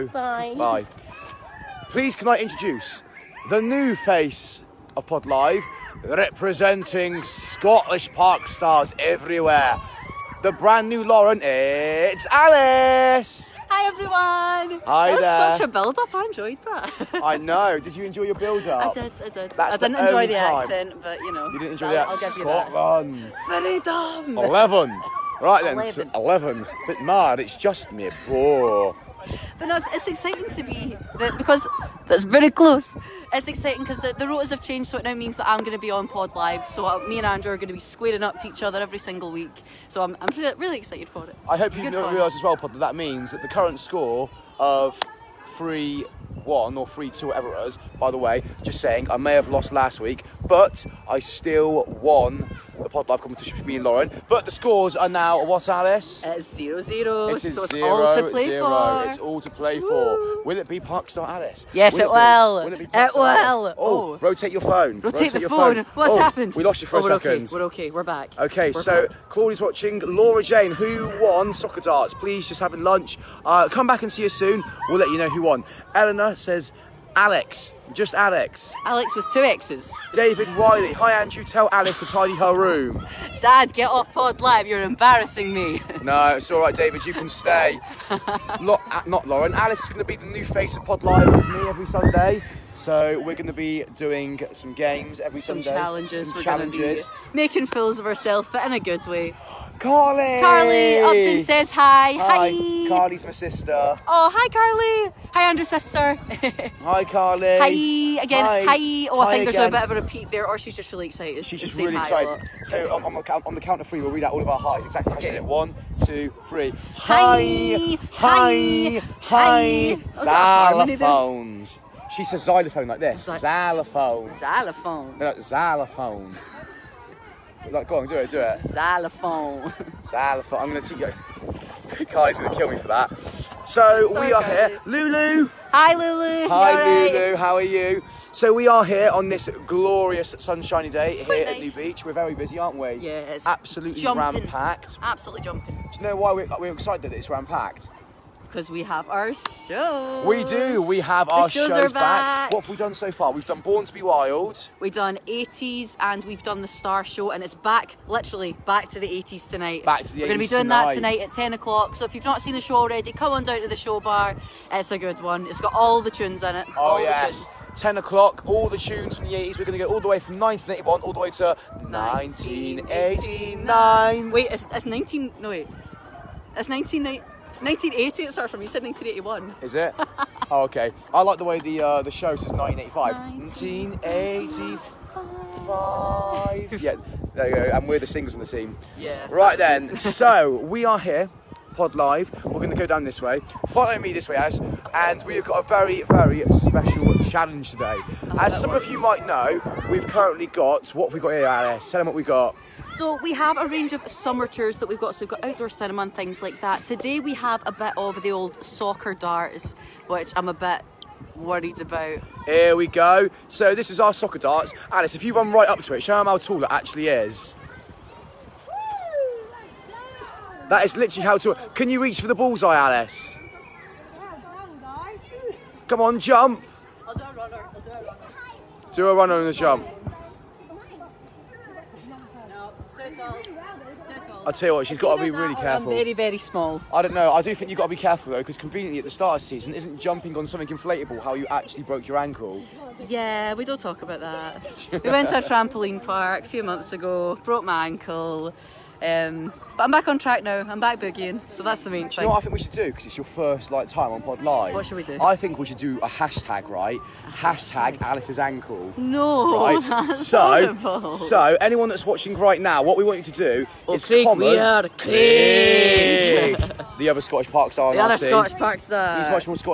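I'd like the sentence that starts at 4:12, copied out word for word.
you know what I think we should do?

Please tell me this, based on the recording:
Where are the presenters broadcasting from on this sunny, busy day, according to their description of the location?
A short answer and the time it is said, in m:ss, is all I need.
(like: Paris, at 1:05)
New Beach, at 2:21.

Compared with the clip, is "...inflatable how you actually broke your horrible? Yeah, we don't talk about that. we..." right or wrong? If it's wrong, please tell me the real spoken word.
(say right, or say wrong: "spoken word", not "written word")
wrong: "ankle", not "horrible".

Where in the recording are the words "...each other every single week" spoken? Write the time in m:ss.
0:38.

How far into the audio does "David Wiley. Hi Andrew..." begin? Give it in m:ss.
1:20.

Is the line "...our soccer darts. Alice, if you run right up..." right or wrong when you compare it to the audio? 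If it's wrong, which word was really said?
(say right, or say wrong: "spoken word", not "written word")
right.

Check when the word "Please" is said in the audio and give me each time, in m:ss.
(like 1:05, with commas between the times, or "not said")
0:01, 1:12.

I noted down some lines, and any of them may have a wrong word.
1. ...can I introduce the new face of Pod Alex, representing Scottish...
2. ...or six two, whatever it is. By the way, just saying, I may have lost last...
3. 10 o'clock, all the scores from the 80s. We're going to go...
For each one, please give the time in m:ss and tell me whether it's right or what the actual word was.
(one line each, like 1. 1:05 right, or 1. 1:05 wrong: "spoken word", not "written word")
1. 0:02 wrong: "Live", not "Alex"
2. 0:46 wrong: "three", not "six"
3. 2:47 wrong: "tunes", not "scores".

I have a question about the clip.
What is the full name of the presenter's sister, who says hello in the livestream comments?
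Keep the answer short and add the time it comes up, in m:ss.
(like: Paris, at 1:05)
Carly Upton, at 1:40.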